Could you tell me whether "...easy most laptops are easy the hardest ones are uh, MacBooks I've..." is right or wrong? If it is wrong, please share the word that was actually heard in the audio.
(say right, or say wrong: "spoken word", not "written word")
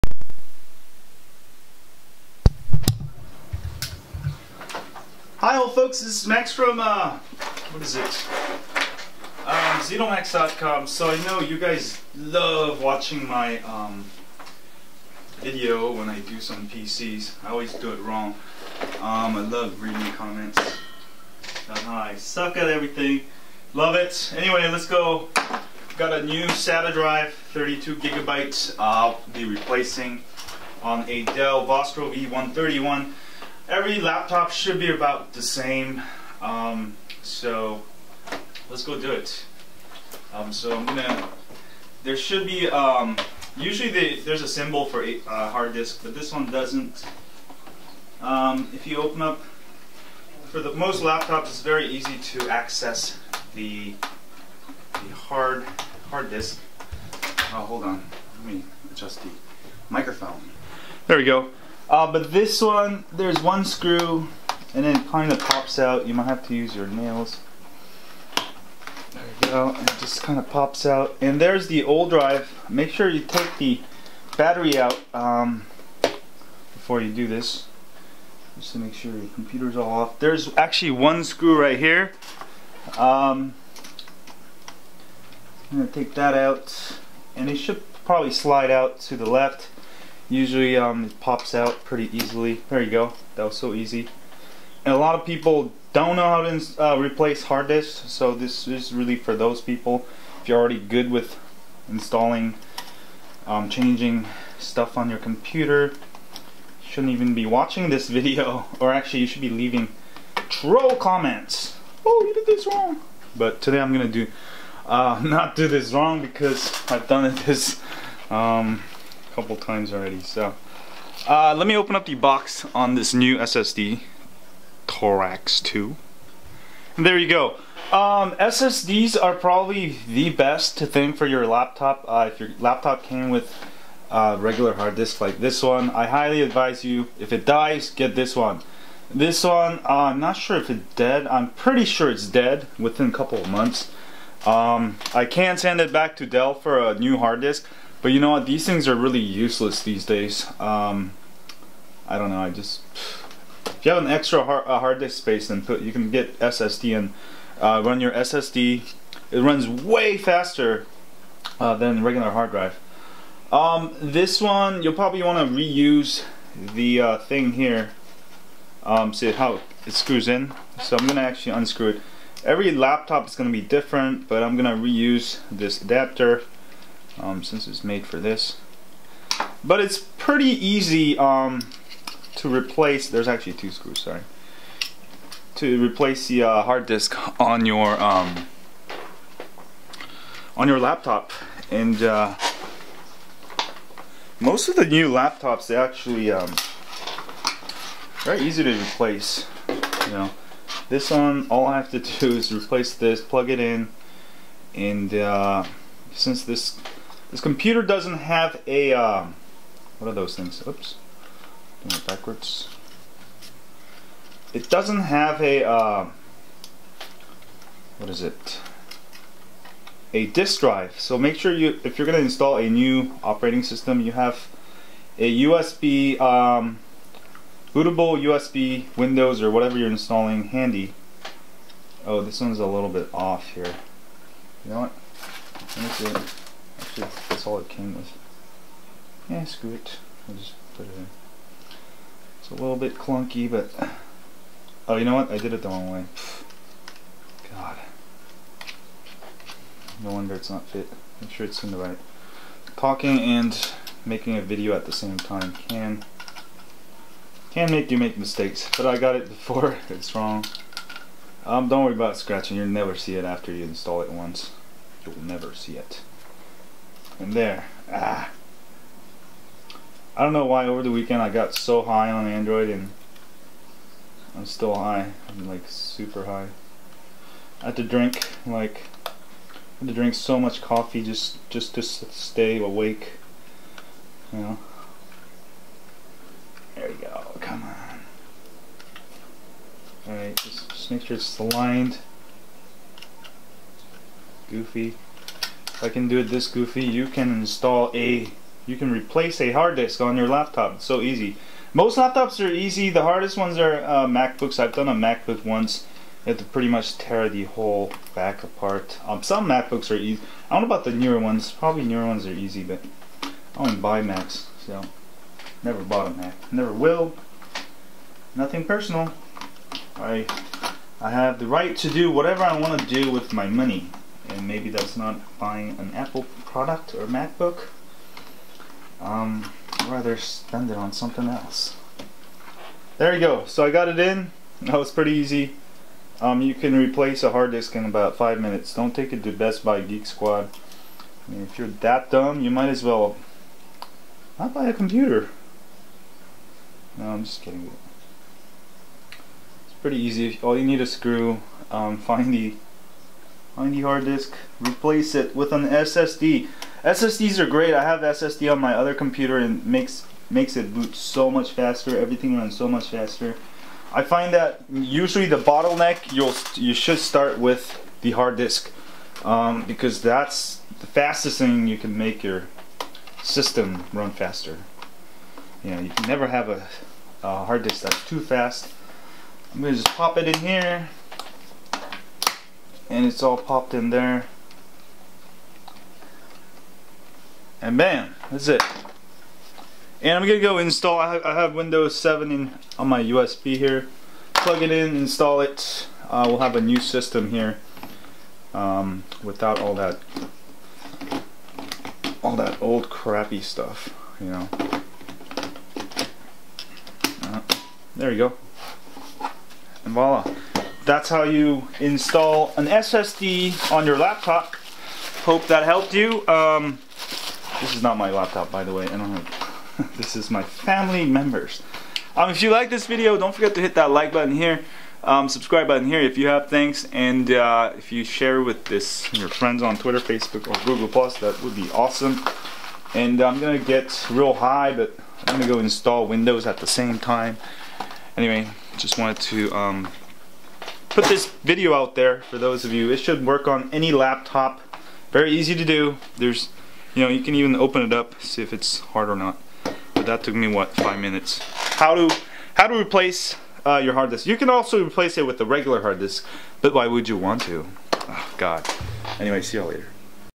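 right.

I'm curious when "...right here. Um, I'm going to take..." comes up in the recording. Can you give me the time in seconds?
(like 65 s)
81 s.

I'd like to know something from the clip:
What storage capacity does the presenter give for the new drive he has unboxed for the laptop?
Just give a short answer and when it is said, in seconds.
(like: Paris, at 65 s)
32 gigabytes, at 27 s.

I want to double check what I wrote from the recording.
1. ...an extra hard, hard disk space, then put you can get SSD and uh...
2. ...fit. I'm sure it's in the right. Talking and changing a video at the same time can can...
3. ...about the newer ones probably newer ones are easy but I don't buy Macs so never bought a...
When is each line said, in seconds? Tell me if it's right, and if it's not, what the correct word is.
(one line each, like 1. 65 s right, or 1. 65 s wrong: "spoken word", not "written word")
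1. 154 s right
2. 250 s wrong: "making", not "changing"
3. 310 s right.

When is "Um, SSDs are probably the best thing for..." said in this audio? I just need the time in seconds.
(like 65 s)
127 s.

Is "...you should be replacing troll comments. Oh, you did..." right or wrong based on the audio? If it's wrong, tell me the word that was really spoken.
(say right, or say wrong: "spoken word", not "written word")
wrong: "leaving", not "replacing".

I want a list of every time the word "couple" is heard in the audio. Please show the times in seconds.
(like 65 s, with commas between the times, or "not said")
119 s, 143 s.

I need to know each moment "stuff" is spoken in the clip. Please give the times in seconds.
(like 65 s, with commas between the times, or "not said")
104 s, 403 s.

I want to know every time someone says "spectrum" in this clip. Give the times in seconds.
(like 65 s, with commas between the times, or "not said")
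not said.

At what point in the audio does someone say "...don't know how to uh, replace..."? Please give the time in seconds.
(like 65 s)
95 s.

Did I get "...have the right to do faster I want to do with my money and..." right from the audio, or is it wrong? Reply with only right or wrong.
wrong.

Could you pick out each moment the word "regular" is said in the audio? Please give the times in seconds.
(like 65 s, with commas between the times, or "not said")
134 s, 162 s, 455 s.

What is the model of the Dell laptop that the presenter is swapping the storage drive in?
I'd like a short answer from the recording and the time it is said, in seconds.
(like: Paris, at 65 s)
Vostro V131, at 31 s.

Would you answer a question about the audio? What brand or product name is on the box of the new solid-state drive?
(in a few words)
Torax 2.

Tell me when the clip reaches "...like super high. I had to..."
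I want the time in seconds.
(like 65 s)
275 s.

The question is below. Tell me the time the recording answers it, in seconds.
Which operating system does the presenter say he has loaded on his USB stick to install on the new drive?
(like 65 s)
391 s.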